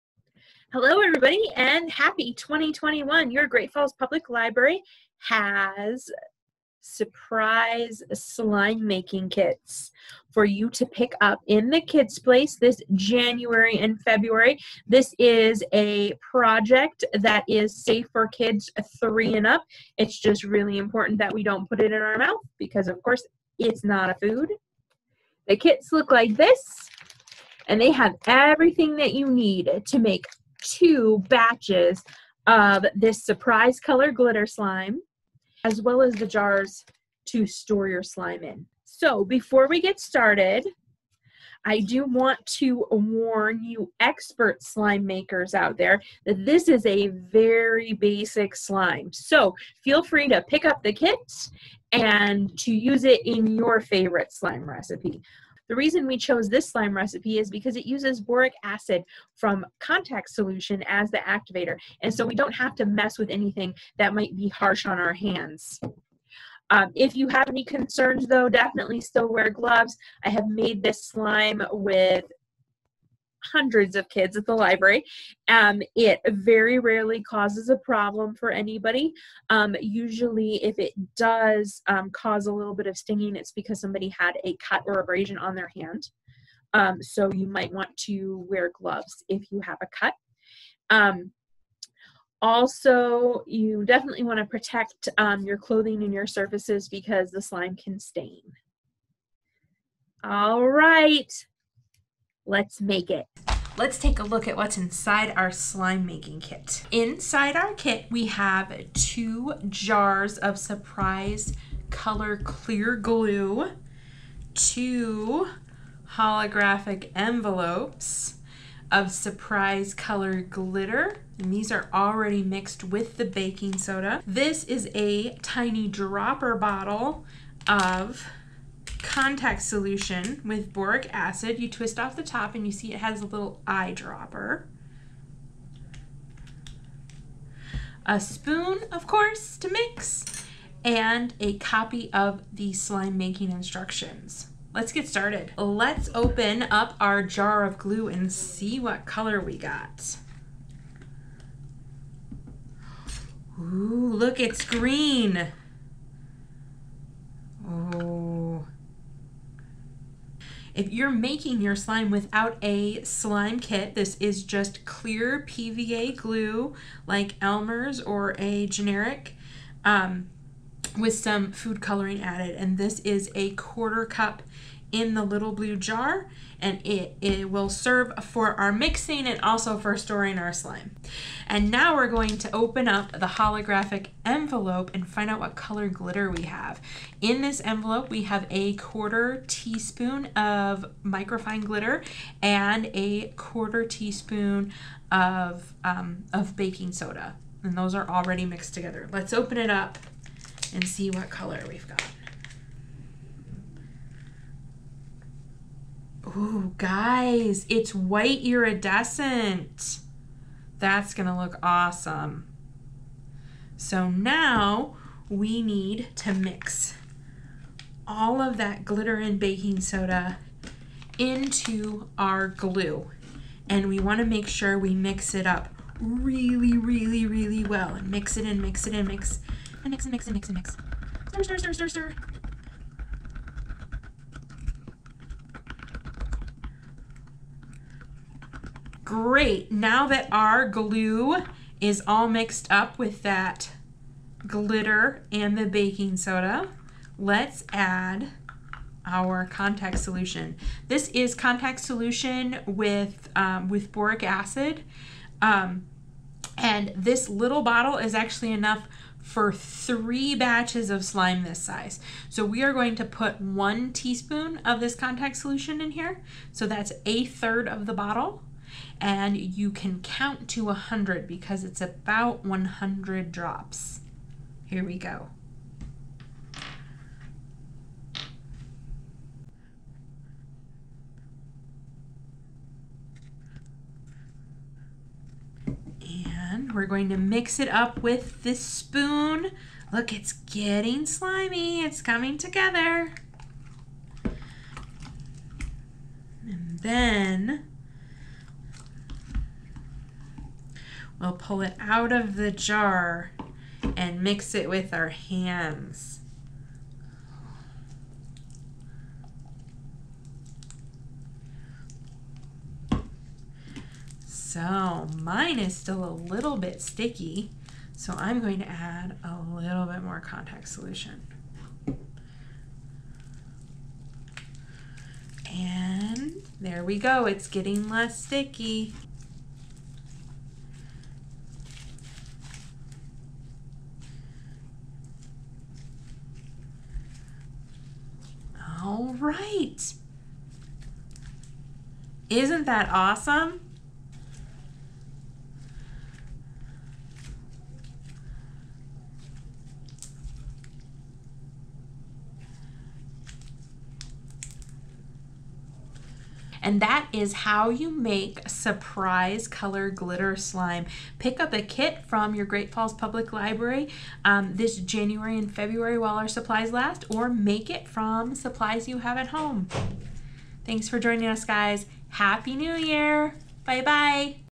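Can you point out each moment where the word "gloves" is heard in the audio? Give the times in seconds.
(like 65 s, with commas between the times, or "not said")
69 s, 88 s.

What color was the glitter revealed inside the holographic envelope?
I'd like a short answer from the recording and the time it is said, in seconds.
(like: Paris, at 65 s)
white iridescent, at 207 s.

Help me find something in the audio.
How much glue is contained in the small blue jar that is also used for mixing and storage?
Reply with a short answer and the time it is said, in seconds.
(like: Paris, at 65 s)
a quarter cup, at 173 s.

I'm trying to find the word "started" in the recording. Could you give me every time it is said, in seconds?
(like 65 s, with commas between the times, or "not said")
39 s, 145 s.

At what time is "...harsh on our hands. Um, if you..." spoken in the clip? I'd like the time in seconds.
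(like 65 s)
64 s.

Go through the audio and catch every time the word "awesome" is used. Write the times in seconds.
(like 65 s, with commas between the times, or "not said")
211 s, 342 s.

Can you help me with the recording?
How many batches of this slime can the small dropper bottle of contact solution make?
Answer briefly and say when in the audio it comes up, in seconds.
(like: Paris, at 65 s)
3, at 259 s.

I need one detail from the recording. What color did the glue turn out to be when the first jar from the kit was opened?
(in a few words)
green.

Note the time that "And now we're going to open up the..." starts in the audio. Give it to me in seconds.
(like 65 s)
181 s.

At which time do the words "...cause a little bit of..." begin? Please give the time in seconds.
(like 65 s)
82 s.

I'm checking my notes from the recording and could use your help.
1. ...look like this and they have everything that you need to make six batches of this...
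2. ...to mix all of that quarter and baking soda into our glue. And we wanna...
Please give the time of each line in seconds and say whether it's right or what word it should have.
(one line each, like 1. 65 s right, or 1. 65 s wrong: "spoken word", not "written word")
1. 25 s wrong: "two", not "six"
2. 216 s wrong: "glitter", not "quarter".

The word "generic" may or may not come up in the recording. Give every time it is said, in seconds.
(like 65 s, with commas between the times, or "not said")
168 s.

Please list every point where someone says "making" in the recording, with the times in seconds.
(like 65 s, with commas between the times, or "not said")
8 s, 106 s, 143 s, 161 s.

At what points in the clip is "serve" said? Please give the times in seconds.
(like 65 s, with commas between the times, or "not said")
177 s.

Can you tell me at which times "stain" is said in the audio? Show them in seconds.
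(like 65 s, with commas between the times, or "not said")
97 s.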